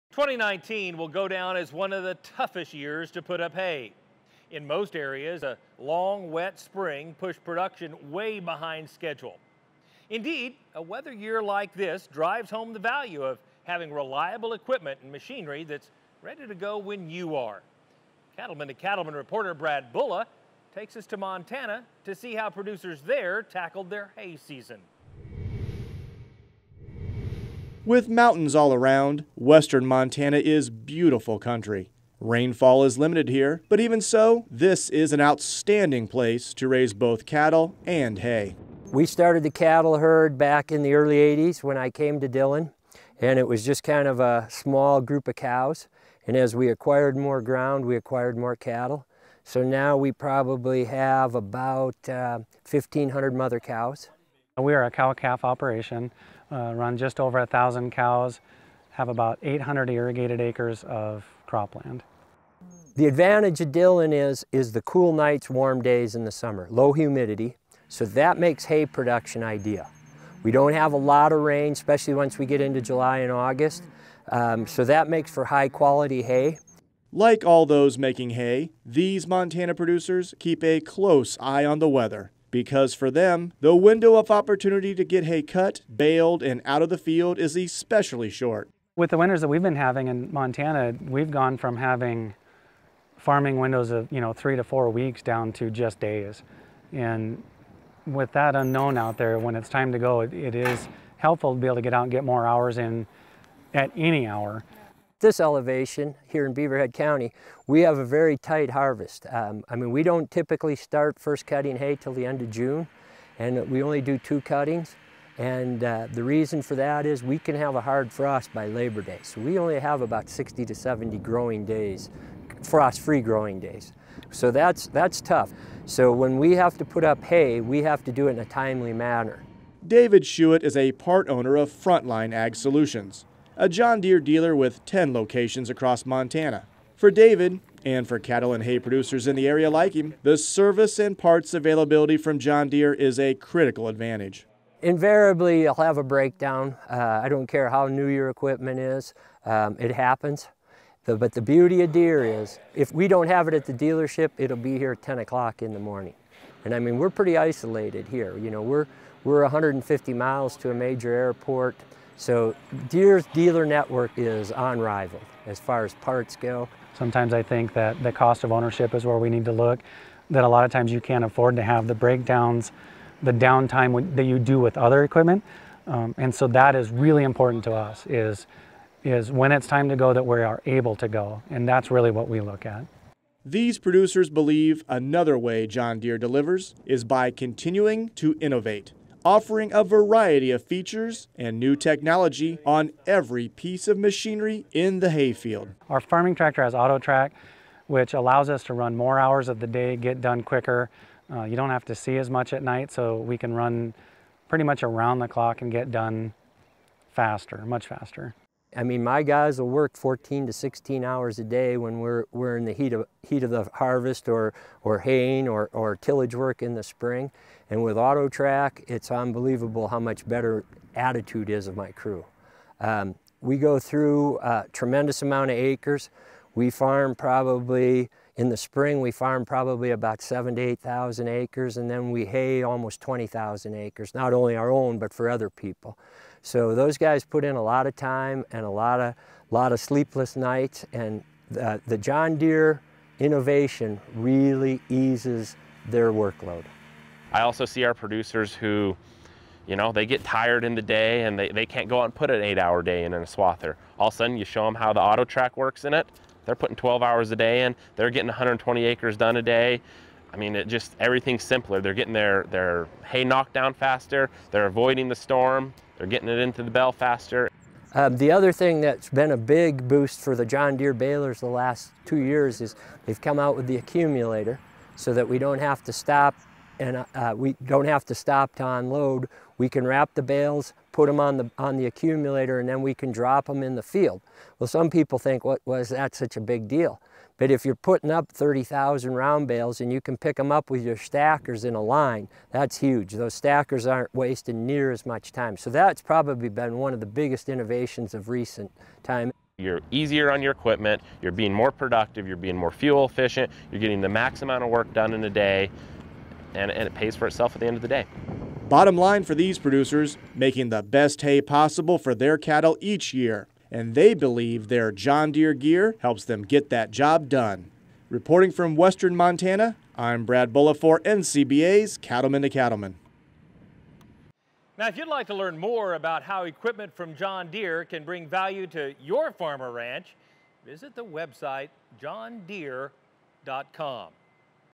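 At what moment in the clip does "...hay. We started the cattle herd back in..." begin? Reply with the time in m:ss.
0:38.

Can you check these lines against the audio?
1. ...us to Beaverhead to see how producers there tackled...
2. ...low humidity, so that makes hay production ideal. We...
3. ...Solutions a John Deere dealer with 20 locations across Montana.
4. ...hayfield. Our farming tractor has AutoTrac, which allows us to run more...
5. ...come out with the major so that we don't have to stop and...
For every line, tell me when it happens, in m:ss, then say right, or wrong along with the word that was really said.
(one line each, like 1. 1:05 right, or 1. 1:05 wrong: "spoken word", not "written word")
1. 0:20 wrong: "Montana", not "Beaverhead"
2. 1:06 right
3. 2:12 wrong: "10", not "20"
4. 3:15 right
5. 4:33 wrong: "accumulator", not "major".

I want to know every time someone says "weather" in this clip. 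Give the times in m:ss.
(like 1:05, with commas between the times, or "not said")
0:10, 1:21.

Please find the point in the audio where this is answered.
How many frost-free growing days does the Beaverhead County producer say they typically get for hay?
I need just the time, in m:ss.
2:00.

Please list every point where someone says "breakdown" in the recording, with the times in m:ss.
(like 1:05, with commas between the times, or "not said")
2:26, 2:51.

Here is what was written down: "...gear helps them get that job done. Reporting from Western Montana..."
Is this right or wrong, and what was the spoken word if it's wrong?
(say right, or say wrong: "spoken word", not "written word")
right.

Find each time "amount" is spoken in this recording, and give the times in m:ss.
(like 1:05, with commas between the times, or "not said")
3:45, 5:04.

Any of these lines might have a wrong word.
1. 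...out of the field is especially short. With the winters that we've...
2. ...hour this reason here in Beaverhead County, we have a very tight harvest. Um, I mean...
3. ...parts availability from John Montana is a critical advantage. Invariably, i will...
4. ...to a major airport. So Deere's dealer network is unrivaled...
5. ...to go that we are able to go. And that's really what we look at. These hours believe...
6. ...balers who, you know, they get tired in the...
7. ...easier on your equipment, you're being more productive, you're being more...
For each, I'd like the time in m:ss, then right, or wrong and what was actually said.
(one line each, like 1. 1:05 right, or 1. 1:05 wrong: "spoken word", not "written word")
1. 1:26 right
2. 1:44 wrong: "elevation", not "reason"
3. 2:21 wrong: "Deere", not "Montana"
4. 2:40 right
5. 2:59 wrong: "producers", not "hours"
6. 4:07 wrong: "producers", not "balers"
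7. 4:59 right.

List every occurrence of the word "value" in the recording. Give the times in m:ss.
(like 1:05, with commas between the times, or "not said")
0:12, 5:28.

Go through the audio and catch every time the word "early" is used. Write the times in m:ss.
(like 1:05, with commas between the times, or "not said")
0:40.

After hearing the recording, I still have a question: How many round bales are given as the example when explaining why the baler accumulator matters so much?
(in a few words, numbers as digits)
30,000.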